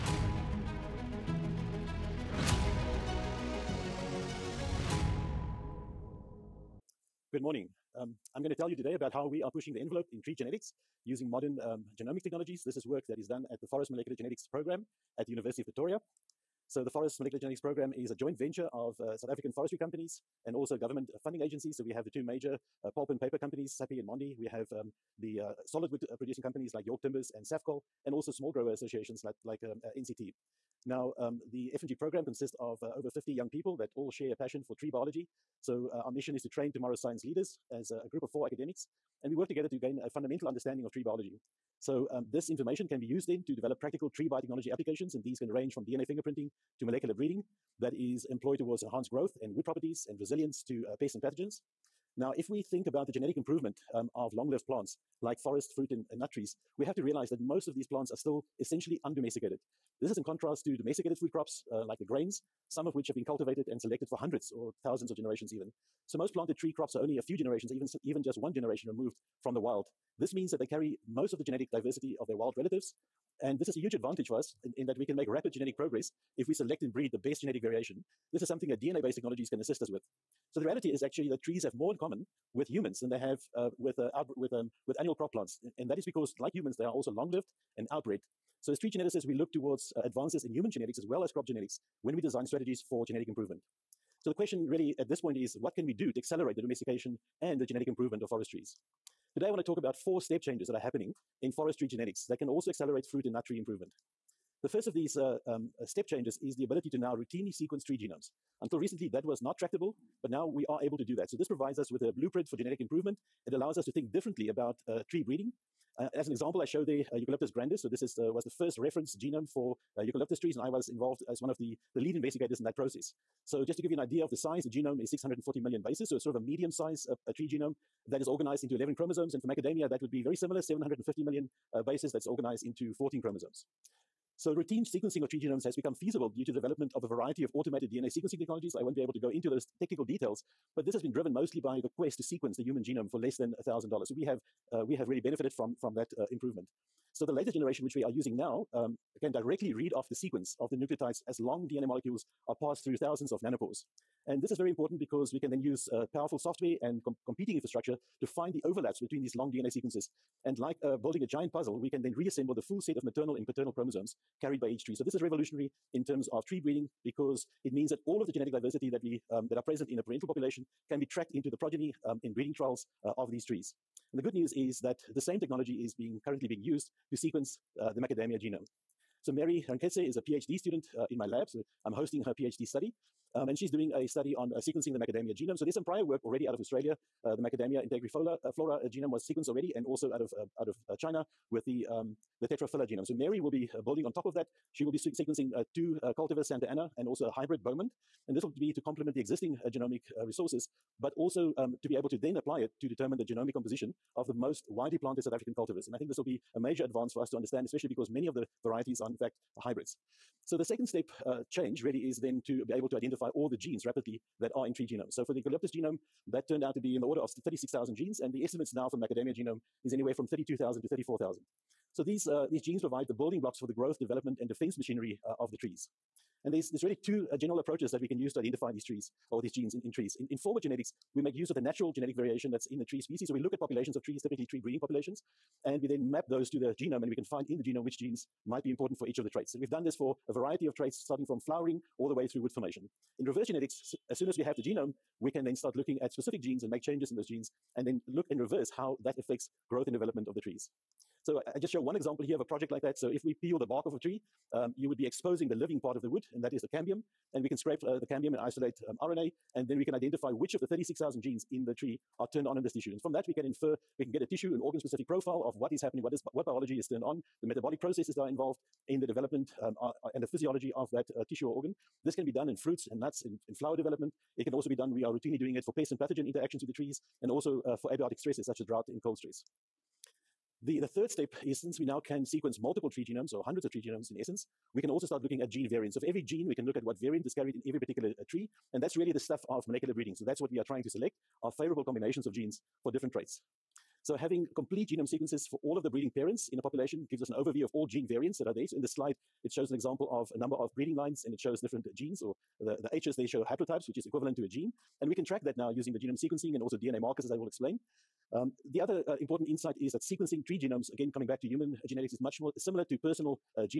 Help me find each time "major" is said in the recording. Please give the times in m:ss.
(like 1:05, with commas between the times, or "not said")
0:22, 3:26.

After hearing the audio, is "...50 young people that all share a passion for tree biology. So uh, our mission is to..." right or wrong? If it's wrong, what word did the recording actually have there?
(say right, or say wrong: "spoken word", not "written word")
right.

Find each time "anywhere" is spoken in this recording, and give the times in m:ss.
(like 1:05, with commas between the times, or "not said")
3:39.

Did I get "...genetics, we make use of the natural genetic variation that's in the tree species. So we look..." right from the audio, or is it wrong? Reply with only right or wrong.
right.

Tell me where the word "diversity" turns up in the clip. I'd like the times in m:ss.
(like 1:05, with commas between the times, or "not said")
1:11, 2:48.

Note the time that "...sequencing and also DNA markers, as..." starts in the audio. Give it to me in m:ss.
5:06.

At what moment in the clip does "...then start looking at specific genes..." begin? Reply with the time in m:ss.
4:05.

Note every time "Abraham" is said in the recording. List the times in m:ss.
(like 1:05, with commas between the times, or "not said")
not said.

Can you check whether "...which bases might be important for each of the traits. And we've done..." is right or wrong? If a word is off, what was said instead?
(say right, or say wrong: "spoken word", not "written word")
wrong: "genes", not "bases".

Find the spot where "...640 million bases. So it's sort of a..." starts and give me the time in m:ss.
2:05.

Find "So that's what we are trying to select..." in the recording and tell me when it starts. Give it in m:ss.
4:50.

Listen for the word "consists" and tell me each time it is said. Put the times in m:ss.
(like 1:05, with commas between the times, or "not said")
0:32.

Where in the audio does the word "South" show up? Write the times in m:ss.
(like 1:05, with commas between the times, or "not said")
0:19, 3:25.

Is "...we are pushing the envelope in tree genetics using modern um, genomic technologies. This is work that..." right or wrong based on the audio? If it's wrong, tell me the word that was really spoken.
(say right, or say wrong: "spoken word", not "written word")
right.